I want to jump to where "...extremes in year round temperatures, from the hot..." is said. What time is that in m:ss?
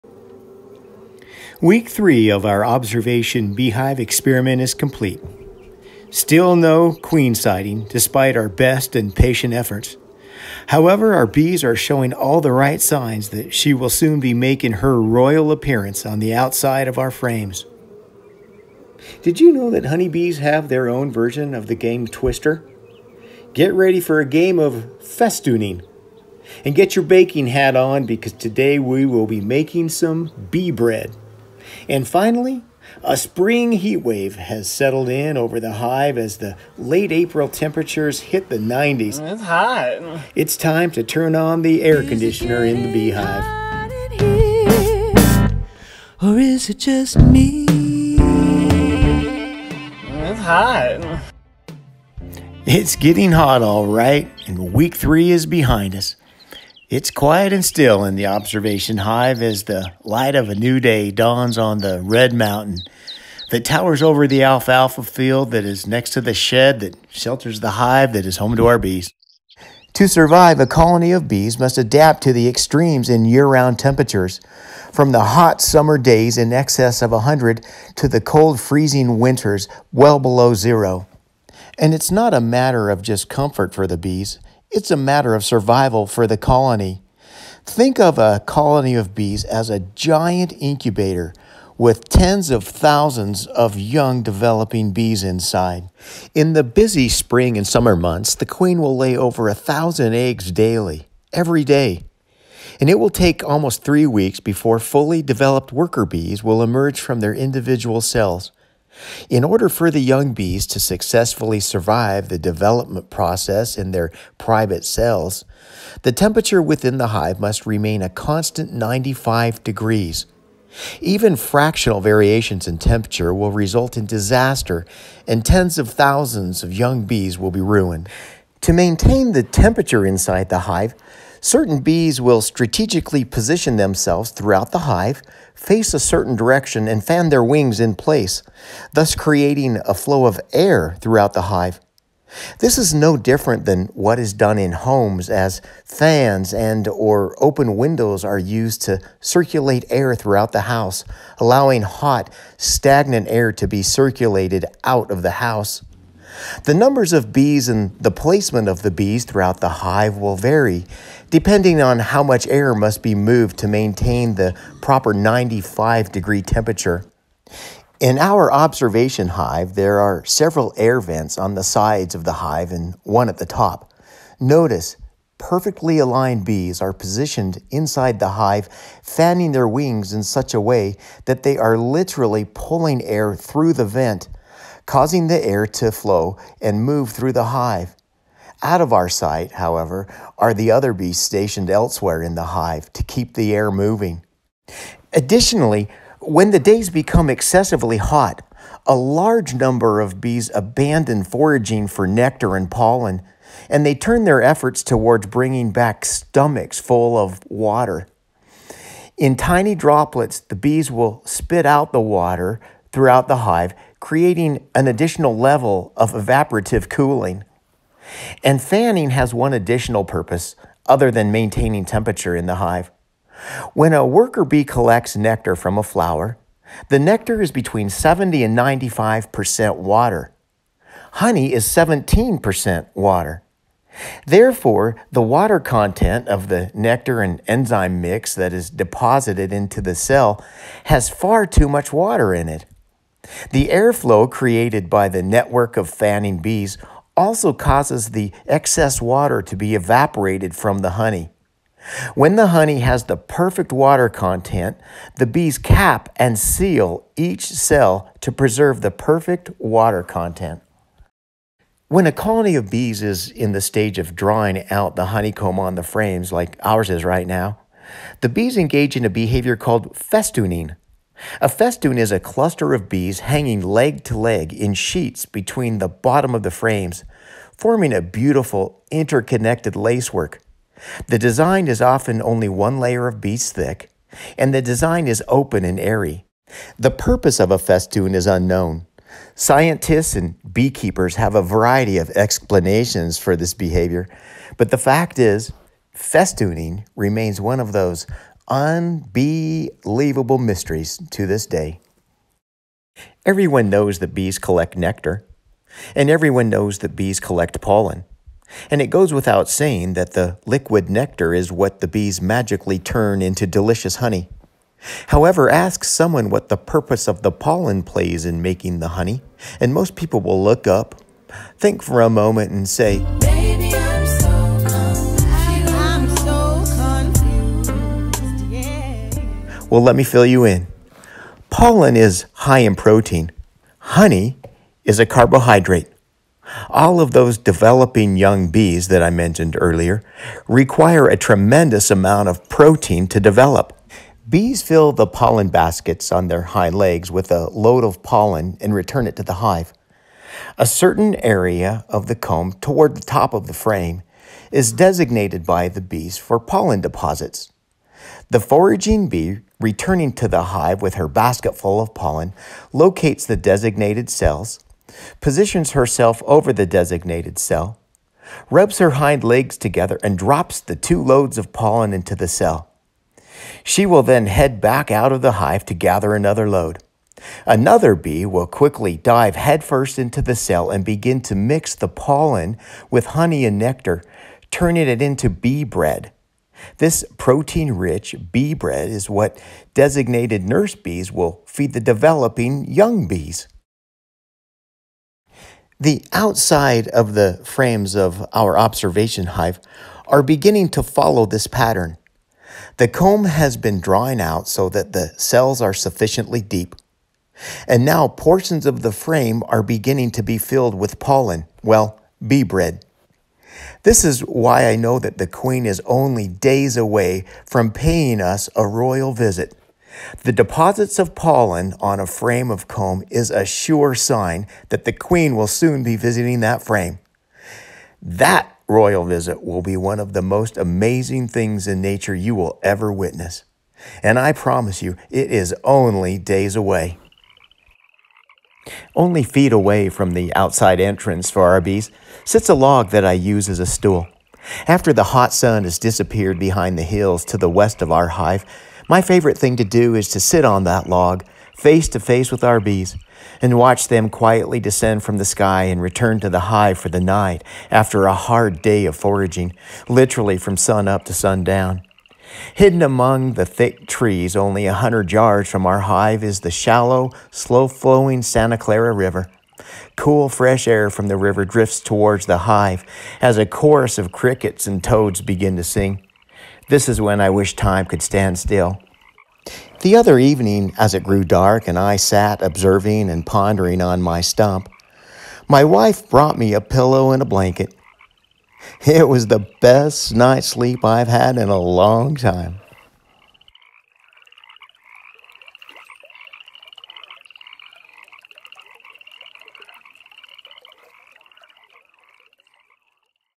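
1:12.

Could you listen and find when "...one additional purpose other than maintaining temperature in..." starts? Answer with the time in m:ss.
3:39.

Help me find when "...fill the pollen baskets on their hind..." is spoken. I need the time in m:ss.
5:44.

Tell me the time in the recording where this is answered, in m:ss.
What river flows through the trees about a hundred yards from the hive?
7:48.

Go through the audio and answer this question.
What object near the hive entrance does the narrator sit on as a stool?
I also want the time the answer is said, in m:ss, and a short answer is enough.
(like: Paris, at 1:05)
a log, at 7:22.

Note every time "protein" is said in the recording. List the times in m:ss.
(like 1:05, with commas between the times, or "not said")
5:32, 5:42, 6:27.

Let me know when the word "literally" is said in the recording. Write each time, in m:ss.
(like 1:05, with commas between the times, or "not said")
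3:01, 7:39.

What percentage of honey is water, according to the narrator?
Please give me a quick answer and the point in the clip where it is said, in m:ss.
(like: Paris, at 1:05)
17%, at 3:51.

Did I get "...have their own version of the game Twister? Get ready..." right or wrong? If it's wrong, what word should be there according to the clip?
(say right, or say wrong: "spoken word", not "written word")
right.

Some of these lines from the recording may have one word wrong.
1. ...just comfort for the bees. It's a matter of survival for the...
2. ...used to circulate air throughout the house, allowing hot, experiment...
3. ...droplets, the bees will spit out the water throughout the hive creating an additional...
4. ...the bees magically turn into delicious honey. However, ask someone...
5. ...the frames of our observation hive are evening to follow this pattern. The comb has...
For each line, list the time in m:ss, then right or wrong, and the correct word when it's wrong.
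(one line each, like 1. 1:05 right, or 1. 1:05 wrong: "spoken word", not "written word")
1. 1:23 right
2. 2:28 wrong: "stagnant", not "experiment"
3. 3:29 right
4. 5:11 right
5. 6:37 wrong: "beginning", not "evening".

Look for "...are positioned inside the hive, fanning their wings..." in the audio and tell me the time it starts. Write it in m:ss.
2:56.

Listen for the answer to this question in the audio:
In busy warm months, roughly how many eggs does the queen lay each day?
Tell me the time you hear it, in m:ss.
1:39.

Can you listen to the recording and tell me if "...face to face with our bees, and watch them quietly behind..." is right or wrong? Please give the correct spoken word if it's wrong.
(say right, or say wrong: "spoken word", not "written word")
wrong: "descend", not "behind".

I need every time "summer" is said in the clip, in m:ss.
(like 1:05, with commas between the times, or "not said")
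1:15, 1:37.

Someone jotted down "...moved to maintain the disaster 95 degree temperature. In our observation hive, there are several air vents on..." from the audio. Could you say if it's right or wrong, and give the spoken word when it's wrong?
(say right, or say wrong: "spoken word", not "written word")
wrong: "proper", not "disaster".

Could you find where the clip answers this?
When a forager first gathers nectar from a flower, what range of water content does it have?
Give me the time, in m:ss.
3:47.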